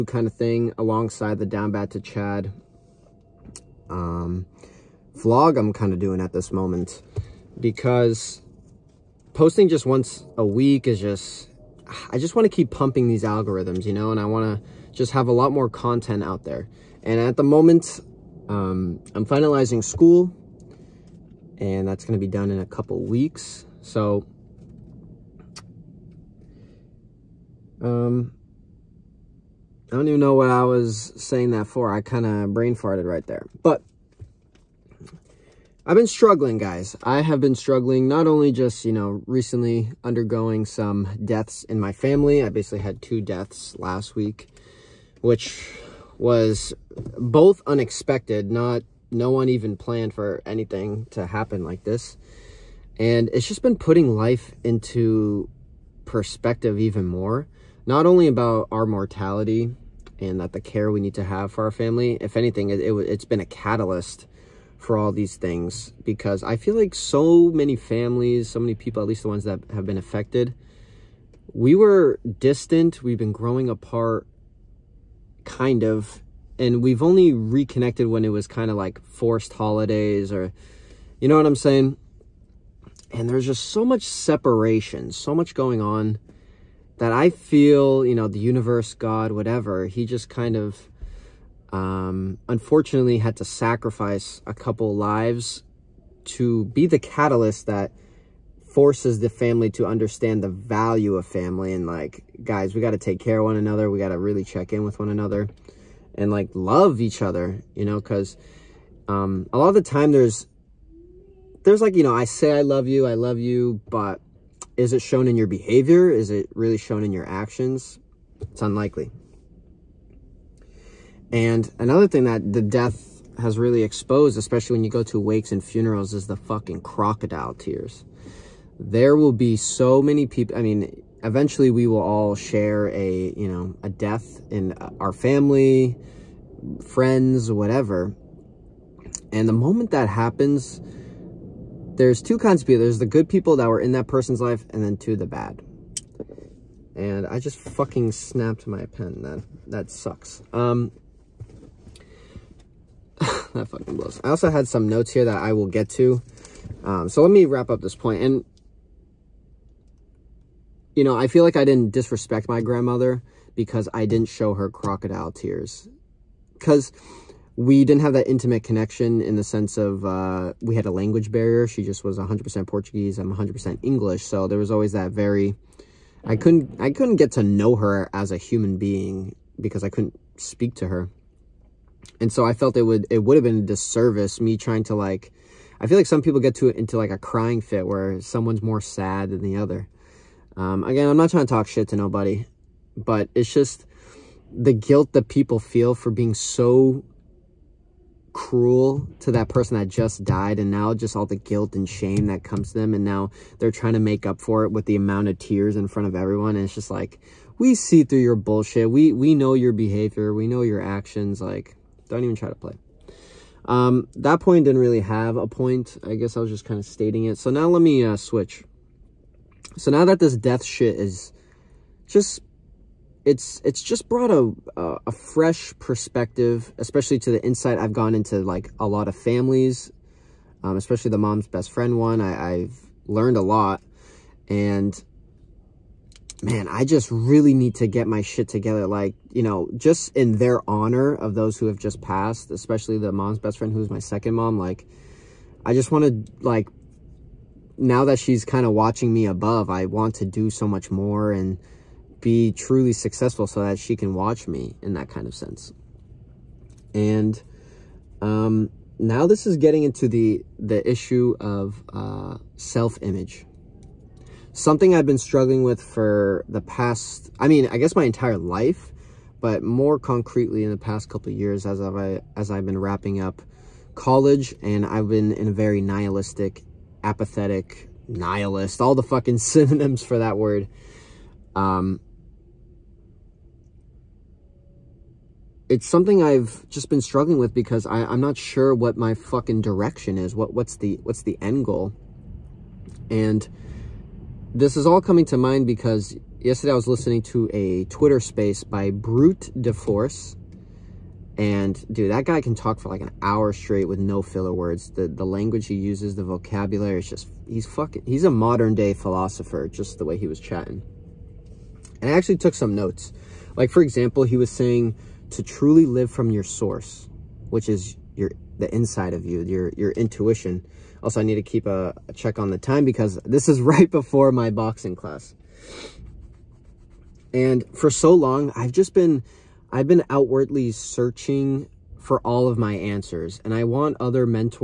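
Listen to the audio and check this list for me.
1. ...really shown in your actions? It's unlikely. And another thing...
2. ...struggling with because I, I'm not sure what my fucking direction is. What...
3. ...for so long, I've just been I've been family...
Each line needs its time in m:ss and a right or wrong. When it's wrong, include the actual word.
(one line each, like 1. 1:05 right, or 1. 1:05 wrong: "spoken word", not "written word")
1. 1:56 right
2. 4:47 right
3. 5:27 wrong: "outwardly", not "family".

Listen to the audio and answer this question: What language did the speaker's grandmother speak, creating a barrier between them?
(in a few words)
Portuguese.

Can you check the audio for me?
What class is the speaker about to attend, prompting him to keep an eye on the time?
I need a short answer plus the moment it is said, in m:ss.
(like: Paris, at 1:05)
boxing class, at 5:24.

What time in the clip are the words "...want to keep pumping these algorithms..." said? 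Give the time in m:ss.
0:12.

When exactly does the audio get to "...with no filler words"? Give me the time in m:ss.
5:03.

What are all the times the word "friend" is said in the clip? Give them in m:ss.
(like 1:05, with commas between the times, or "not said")
2:16, 3:51, 4:03.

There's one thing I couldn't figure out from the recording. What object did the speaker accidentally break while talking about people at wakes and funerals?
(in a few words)
pen.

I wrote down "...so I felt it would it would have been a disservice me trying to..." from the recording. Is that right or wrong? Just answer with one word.
right.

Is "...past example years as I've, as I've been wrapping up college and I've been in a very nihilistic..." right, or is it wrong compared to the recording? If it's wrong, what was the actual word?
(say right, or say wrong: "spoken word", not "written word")
wrong: "couple", not "example".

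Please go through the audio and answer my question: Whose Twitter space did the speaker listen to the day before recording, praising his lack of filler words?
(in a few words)
Brute DeForce.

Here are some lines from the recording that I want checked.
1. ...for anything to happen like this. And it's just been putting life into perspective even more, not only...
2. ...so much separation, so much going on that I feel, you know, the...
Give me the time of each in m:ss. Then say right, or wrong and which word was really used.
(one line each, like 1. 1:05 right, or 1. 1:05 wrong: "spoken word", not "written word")
1. 0:50 right
2. 1:23 right.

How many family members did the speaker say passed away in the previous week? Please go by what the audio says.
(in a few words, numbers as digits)
2.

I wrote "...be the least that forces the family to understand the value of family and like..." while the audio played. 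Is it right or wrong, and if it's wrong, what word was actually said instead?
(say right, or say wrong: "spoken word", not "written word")
wrong: "catalyst", not "least".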